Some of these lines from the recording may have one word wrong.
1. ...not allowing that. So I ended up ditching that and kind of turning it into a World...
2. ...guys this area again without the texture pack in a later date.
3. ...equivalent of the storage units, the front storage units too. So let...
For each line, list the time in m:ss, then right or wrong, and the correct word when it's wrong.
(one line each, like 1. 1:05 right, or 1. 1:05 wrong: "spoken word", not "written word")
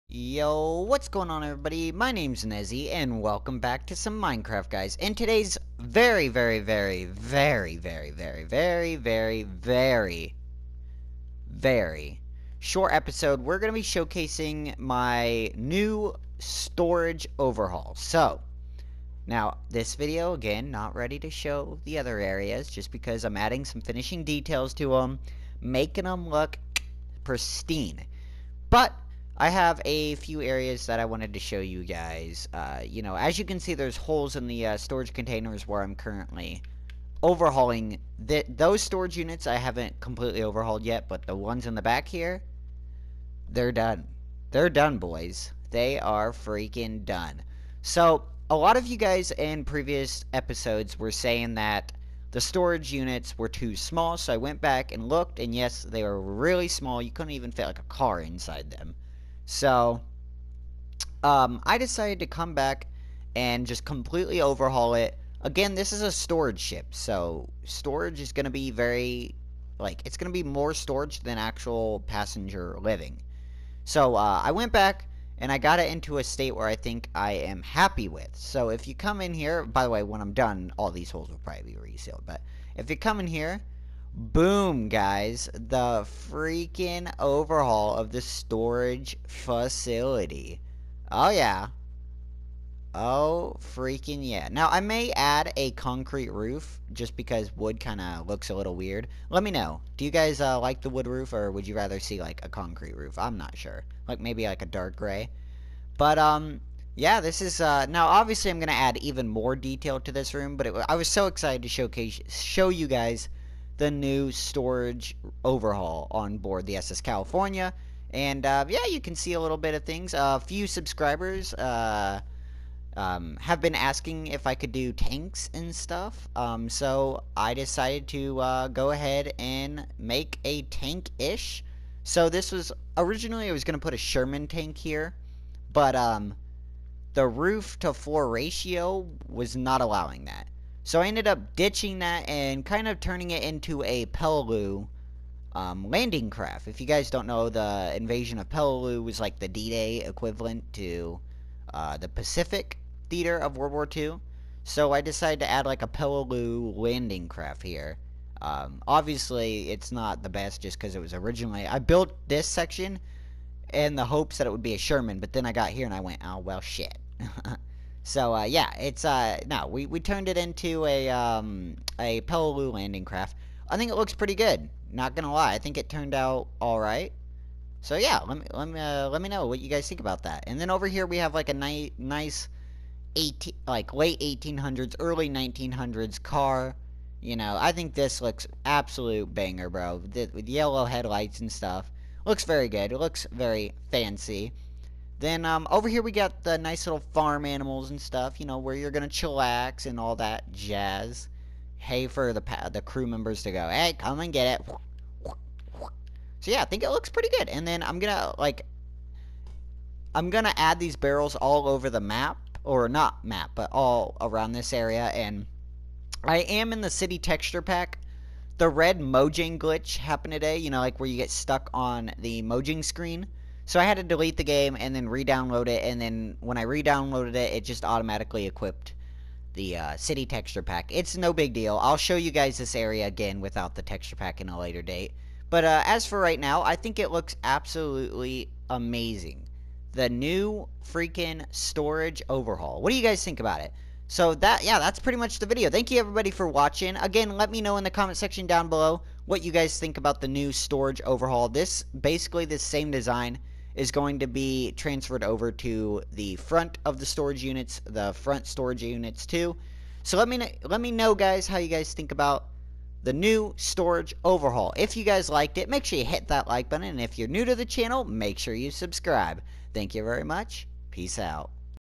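1. 2:19 wrong: "Peleliu", not "World"
2. 3:52 right
3. 4:16 wrong: "front", not "equivalent".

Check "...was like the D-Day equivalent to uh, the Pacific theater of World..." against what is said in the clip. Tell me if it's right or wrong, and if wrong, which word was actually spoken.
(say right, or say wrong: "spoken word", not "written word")
right.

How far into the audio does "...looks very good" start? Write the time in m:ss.
3:12.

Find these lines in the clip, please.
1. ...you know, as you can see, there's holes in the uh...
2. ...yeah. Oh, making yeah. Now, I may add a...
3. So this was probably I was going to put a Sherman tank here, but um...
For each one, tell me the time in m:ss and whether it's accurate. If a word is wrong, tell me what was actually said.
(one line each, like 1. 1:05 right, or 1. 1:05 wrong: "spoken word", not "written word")
1. 0:32 right
2. 1:31 wrong: "freaking", not "making"
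3. 2:12 wrong: "originally", not "probably".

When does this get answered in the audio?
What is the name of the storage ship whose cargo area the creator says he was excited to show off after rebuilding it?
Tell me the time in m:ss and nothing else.
1:56.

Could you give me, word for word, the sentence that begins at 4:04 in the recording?
So that, yeah, that's pretty much the video.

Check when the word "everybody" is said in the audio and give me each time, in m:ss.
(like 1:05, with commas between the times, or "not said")
0:01, 4:06.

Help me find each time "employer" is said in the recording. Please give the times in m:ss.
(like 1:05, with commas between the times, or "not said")
not said.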